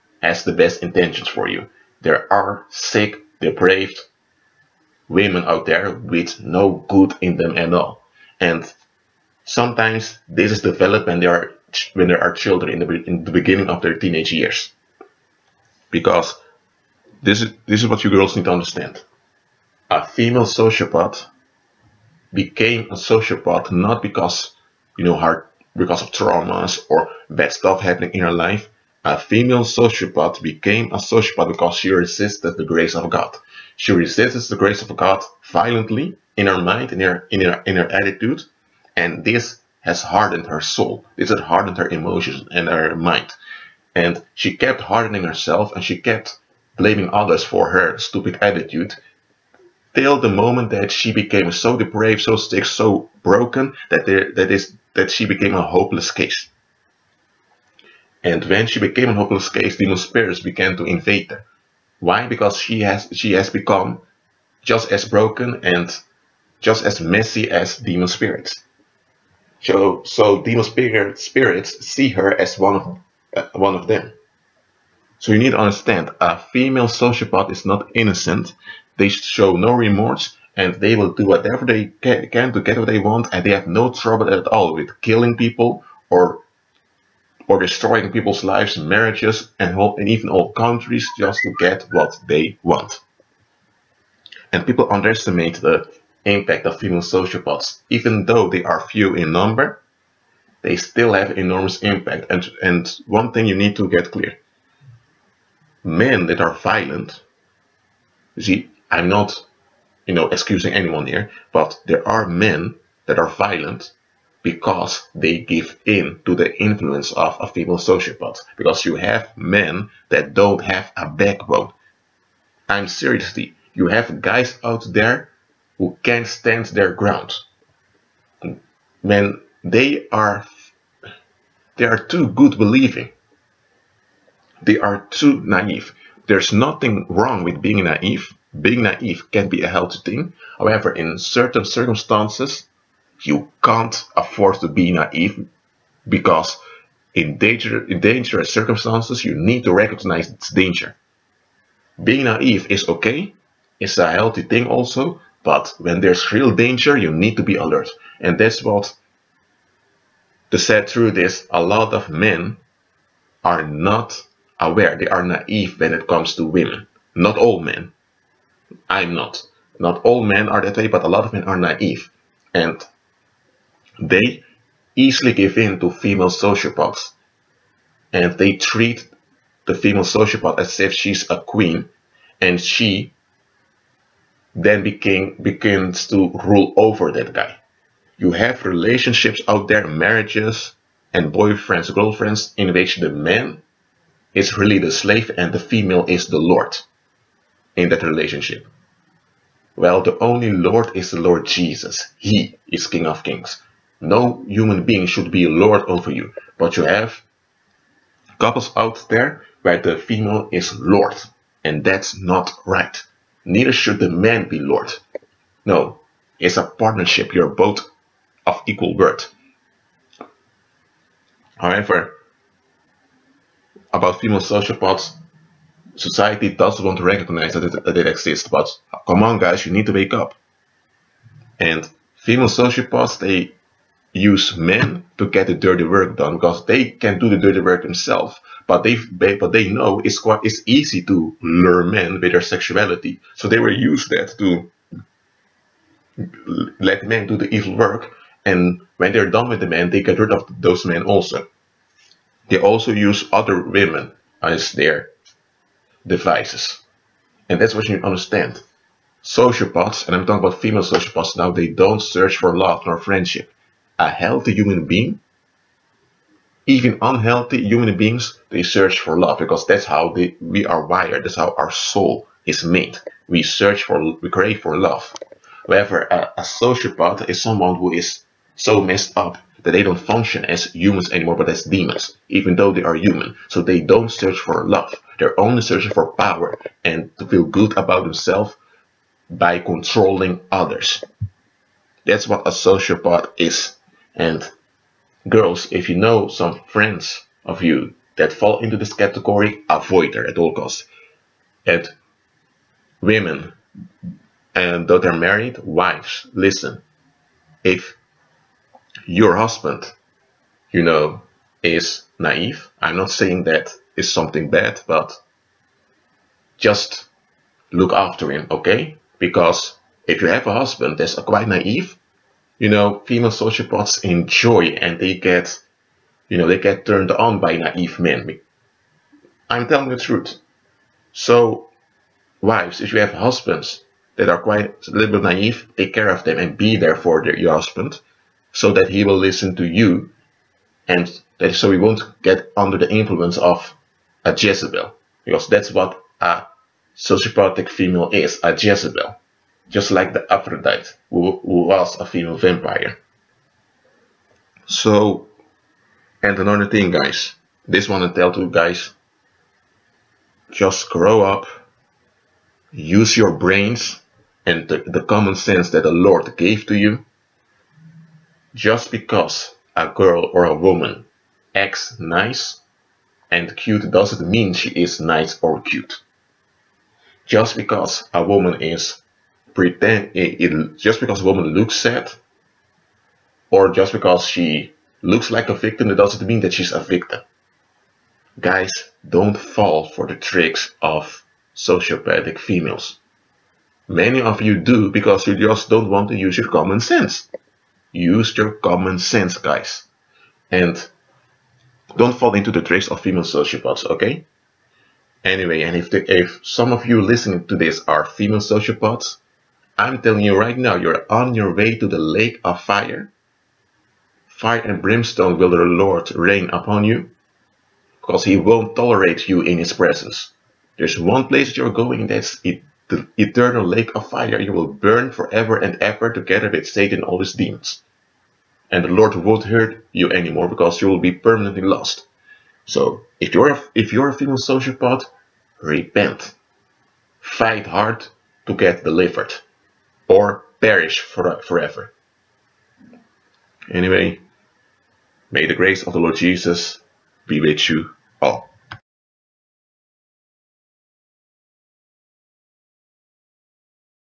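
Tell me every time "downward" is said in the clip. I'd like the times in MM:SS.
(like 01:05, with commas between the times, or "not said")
not said.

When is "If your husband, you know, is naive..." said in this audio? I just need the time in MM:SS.
05:07.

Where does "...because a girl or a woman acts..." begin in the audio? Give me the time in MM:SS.
06:08.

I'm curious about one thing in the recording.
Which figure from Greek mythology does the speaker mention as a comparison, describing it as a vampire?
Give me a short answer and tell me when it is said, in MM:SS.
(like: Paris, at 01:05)
Aphrodite, at 05:50.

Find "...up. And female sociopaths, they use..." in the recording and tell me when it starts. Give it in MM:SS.
03:50.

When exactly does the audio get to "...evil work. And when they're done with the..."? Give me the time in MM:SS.
04:07.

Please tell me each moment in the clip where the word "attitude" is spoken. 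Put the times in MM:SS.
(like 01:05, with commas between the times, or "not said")
00:37, 00:48.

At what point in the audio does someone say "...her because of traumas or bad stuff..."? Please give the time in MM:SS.
00:25.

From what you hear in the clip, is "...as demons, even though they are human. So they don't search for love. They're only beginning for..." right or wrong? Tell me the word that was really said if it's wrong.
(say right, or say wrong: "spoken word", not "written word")
wrong: "searching", not "beginning".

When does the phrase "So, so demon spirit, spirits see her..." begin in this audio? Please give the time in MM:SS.
01:09.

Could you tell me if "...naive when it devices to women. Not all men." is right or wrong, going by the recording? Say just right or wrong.
wrong.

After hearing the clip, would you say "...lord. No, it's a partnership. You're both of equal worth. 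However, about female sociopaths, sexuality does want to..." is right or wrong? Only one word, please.
wrong.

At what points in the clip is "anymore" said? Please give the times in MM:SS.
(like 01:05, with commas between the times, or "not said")
04:41, 07:10.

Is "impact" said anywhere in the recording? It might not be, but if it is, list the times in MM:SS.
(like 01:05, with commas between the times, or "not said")
01:36, 01:41.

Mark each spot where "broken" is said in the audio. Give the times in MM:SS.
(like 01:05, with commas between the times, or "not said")
00:53, 01:05.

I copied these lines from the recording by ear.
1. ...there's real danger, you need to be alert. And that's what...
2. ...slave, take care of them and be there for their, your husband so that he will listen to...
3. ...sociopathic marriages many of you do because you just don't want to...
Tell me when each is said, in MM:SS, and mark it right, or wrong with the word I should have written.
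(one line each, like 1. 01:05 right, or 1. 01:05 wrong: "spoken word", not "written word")
1. 02:35 right
2. 05:35 wrong: "naive", not "slave"
3. 06:31 wrong: "females", not "marriages".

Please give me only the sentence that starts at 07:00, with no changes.
There's one place you're going, that's it, the eternal lake of fire.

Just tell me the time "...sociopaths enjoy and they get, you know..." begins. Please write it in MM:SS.
05:23.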